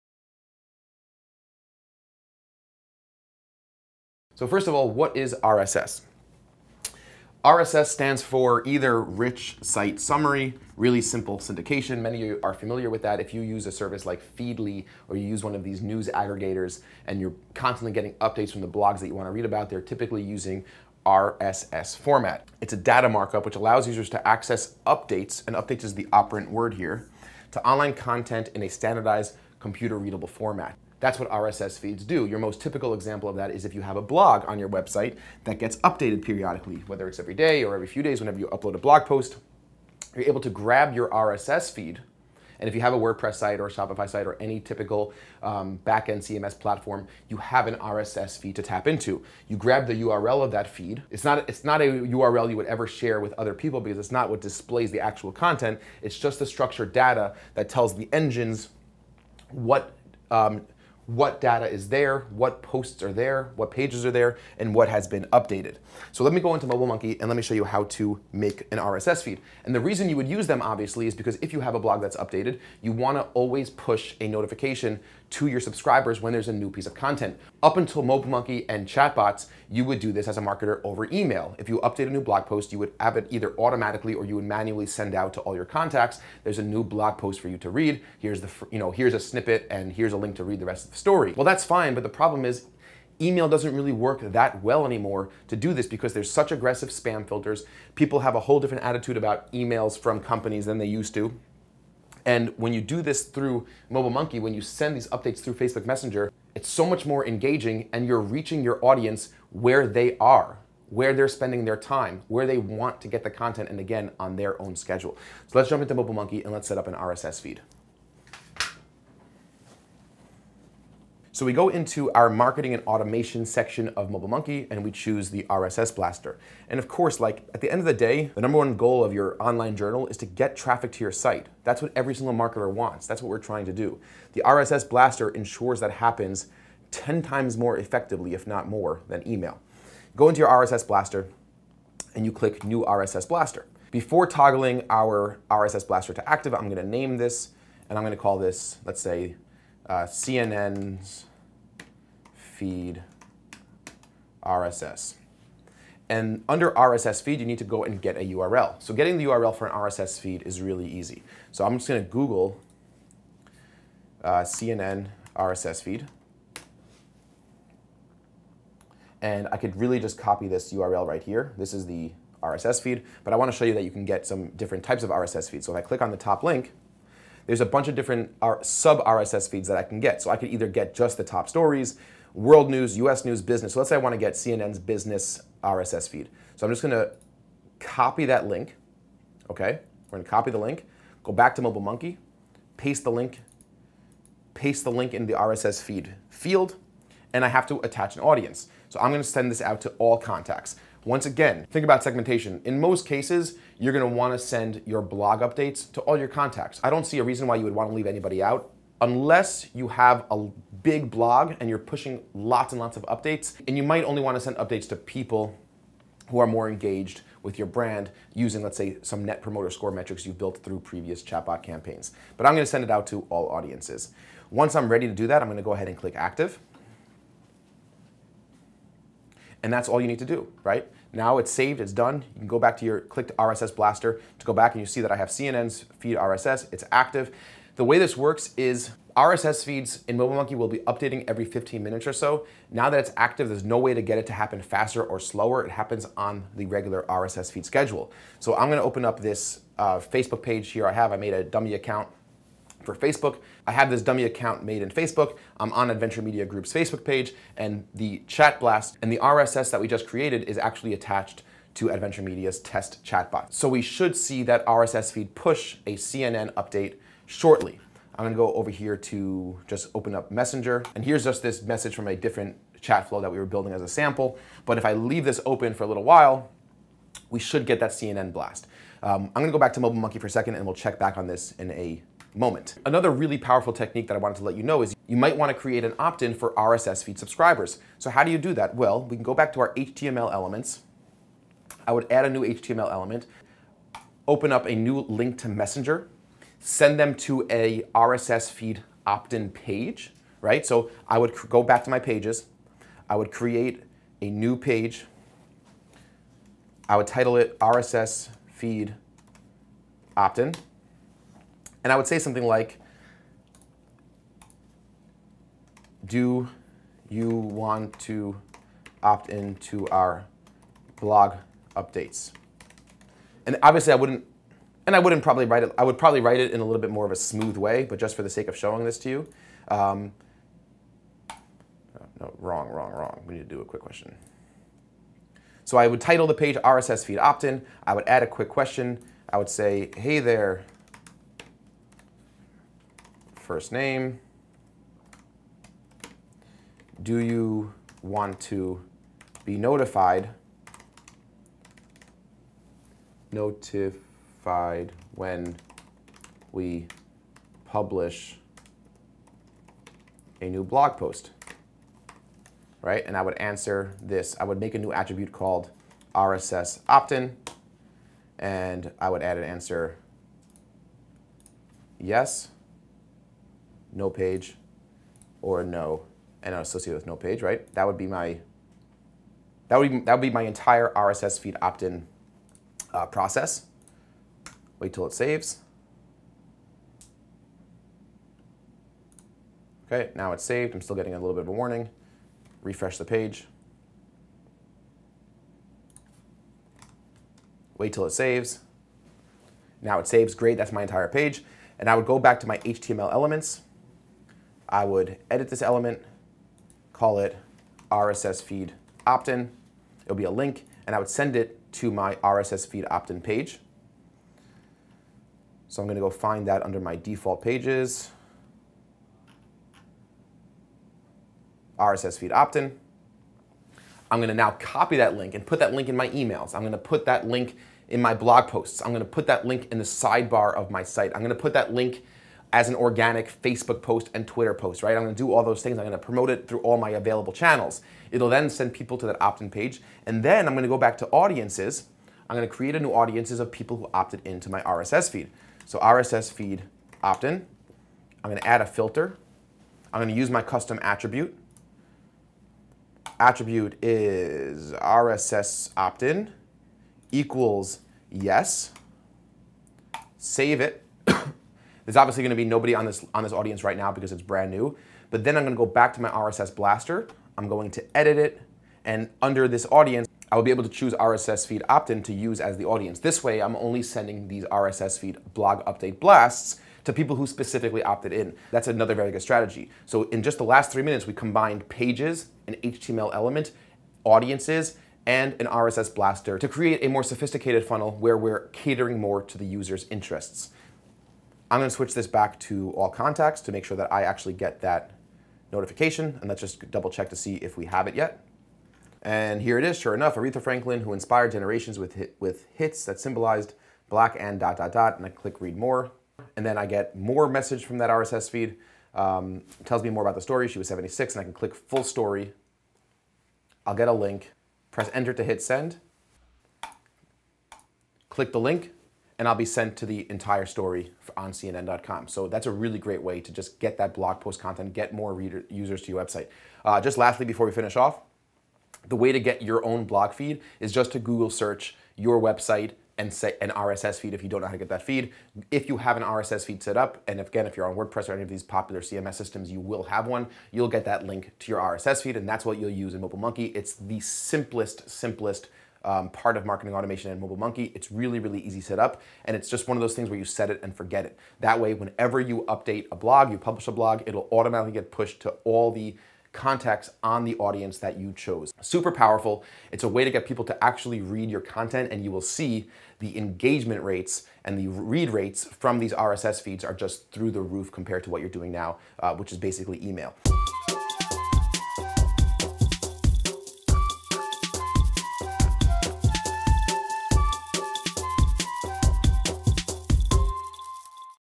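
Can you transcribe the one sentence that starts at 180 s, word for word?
So I could either get just the top stories, world news, US news, business.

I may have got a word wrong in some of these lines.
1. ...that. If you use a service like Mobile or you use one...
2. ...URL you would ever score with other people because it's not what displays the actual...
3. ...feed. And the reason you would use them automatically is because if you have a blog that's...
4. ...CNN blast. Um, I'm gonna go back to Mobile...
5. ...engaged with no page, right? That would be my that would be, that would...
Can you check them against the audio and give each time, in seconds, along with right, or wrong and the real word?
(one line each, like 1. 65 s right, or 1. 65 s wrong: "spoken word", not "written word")
1. 13 s wrong: "Feedly", not "Mobile"
2. 51 s wrong: "share", not "score"
3. 69 s wrong: "obviously", not "automatically"
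4. 277 s right
5. 376 s wrong: "associated", not "engaged".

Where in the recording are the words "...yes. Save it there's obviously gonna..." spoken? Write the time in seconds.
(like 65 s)
458 s.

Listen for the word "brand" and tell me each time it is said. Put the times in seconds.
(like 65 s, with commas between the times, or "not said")
217 s, 464 s.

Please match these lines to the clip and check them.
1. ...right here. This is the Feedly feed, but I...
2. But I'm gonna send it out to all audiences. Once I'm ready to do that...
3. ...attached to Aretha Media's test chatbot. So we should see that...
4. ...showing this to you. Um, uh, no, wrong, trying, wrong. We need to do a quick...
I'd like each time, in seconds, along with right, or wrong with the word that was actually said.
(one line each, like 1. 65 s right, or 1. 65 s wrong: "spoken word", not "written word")
1. 171 s wrong: "RSS", not "Feedly"
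2. 222 s right
3. 260 s wrong: "Adventure", not "Aretha"
4. 328 s wrong: "wrong", not "trying".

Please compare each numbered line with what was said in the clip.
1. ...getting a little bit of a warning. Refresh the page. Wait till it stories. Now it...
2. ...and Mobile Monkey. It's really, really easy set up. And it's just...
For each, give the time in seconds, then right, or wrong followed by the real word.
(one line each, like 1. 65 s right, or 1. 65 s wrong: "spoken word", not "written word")
1. 390 s wrong: "saves", not "stories"
2. 547 s right.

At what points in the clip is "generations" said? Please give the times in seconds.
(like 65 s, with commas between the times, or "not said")
501 s.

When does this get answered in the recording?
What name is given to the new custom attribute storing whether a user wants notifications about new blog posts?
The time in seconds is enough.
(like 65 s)
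366 s.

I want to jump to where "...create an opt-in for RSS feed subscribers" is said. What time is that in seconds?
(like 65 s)
285 s.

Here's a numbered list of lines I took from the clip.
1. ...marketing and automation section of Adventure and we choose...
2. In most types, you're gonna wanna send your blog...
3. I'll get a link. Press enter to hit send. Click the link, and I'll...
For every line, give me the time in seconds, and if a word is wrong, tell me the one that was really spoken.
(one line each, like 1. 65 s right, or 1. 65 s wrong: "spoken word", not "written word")
1. 122 s wrong: "MobileMonkey", not "Adventure"
2. 202 s wrong: "cases", not "types"
3. 513 s right.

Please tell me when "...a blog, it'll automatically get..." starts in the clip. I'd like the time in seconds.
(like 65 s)
553 s.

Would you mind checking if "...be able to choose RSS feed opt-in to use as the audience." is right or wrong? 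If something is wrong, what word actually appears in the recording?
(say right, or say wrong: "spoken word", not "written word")
right.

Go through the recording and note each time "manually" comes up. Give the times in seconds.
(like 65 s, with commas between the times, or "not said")
84 s.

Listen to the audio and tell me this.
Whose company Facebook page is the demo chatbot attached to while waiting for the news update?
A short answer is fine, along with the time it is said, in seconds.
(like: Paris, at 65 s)
Adventure Media Group, at 255 s.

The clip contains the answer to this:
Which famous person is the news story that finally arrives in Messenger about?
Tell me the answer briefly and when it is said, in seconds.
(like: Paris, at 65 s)
Aretha Franklin, at 500 s.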